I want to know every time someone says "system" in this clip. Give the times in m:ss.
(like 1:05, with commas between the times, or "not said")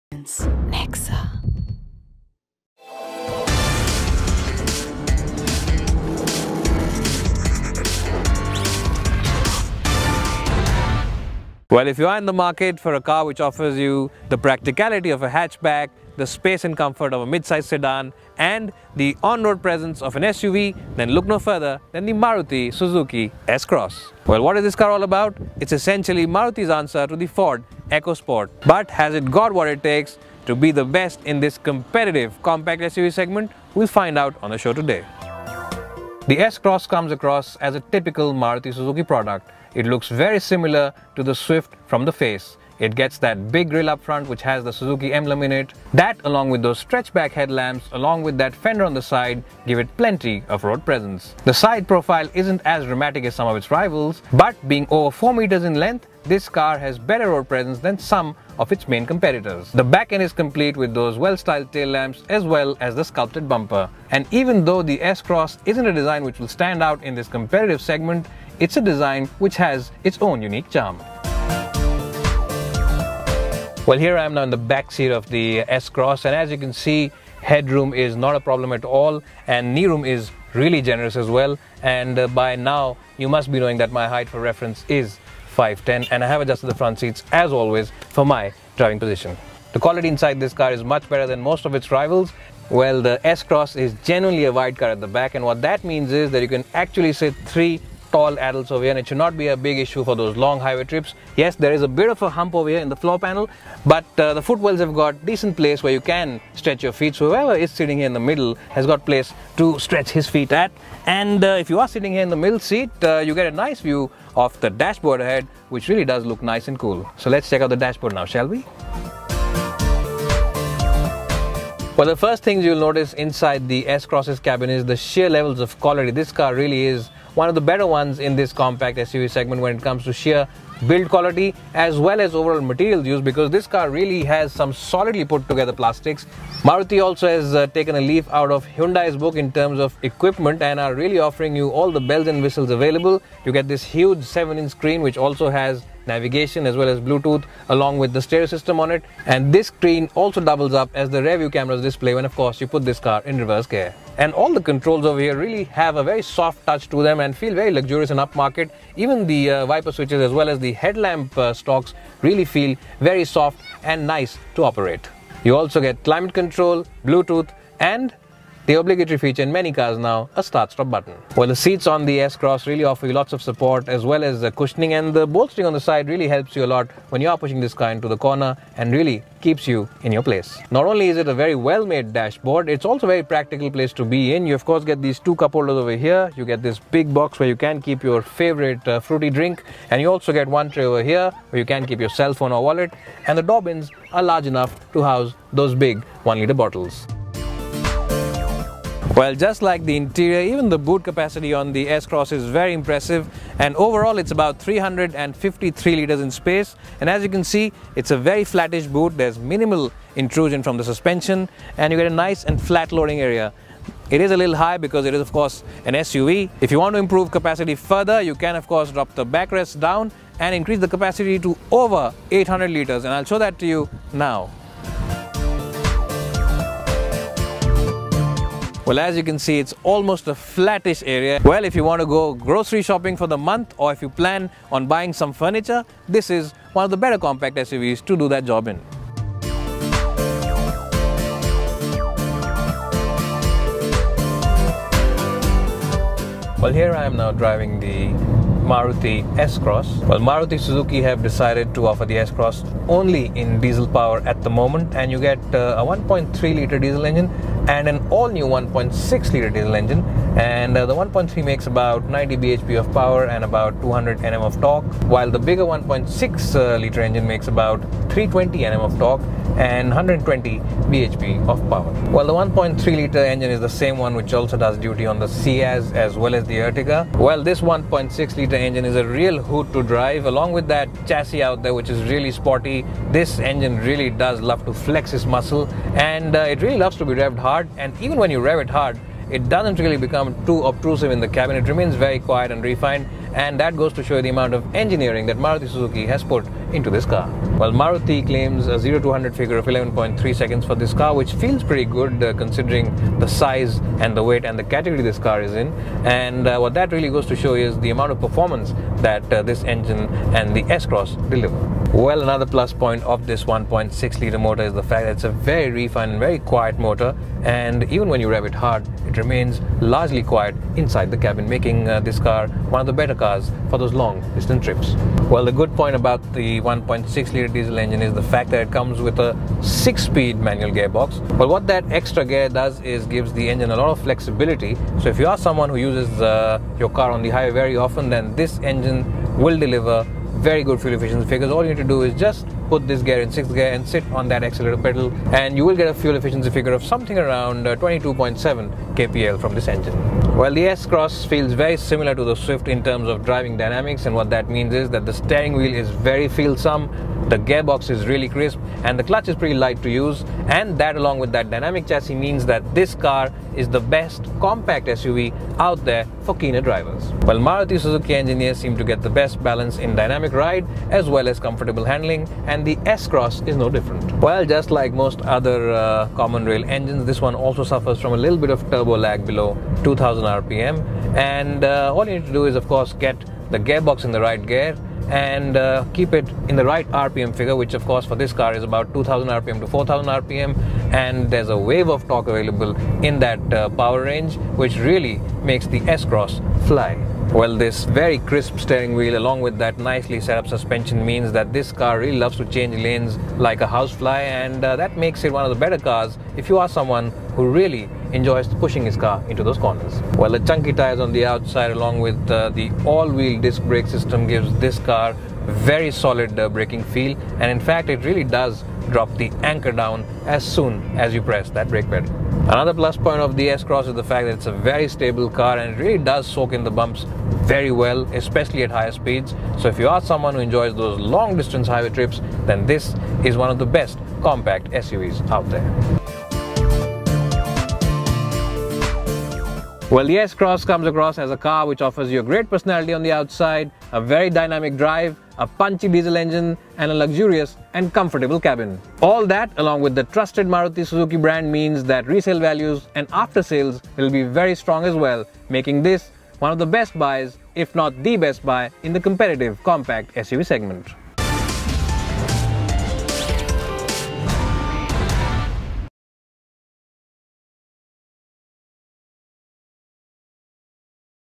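2:28, 6:53.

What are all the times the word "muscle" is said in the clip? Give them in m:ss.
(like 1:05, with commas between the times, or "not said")
4:45.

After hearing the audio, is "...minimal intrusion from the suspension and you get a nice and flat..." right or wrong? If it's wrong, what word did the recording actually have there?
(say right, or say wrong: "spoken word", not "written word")
right.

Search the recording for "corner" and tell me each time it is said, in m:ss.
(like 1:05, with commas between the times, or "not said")
2:58, 6:49.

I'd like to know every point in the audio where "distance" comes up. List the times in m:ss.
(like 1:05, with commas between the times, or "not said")
5:24, 7:11.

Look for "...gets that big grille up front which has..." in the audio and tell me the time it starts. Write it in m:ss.
0:42.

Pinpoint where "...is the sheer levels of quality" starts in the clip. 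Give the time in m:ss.
2:04.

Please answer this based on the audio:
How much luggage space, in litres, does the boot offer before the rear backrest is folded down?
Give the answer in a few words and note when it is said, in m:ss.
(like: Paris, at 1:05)
353 litres, at 3:24.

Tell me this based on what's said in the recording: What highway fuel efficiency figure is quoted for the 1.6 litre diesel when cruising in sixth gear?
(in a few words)
22.7 kpl.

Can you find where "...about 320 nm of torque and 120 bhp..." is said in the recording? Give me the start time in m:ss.
4:27.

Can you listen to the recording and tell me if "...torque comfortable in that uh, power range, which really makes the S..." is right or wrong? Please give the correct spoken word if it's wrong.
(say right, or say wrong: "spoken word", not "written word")
wrong: "available", not "comfortable".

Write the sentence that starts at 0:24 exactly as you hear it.
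Well, what is this car all about?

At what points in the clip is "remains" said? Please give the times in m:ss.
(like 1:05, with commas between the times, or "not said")
4:51, 5:19.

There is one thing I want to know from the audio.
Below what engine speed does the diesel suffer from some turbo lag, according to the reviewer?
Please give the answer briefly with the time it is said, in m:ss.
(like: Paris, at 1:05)
2000 RPM, at 6:19.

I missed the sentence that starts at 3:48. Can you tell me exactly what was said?
Well, as you can see, it's almost a flattish area.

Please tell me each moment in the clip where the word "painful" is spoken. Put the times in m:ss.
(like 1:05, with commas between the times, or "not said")
not said.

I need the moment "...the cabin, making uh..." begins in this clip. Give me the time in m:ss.
5:21.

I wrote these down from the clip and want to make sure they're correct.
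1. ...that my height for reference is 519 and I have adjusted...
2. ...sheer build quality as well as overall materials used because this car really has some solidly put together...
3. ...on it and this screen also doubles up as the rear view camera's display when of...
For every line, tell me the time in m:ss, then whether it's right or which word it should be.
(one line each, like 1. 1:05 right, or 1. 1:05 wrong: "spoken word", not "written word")
1. 1:23 wrong: "510", not "519"
2. 2:10 right
3. 2:28 right.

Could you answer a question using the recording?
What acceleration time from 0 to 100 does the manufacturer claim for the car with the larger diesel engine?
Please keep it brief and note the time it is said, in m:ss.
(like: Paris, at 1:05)
11.3 seconds, at 4:59.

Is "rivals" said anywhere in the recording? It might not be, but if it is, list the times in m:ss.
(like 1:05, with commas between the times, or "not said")
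0:53, 1:31.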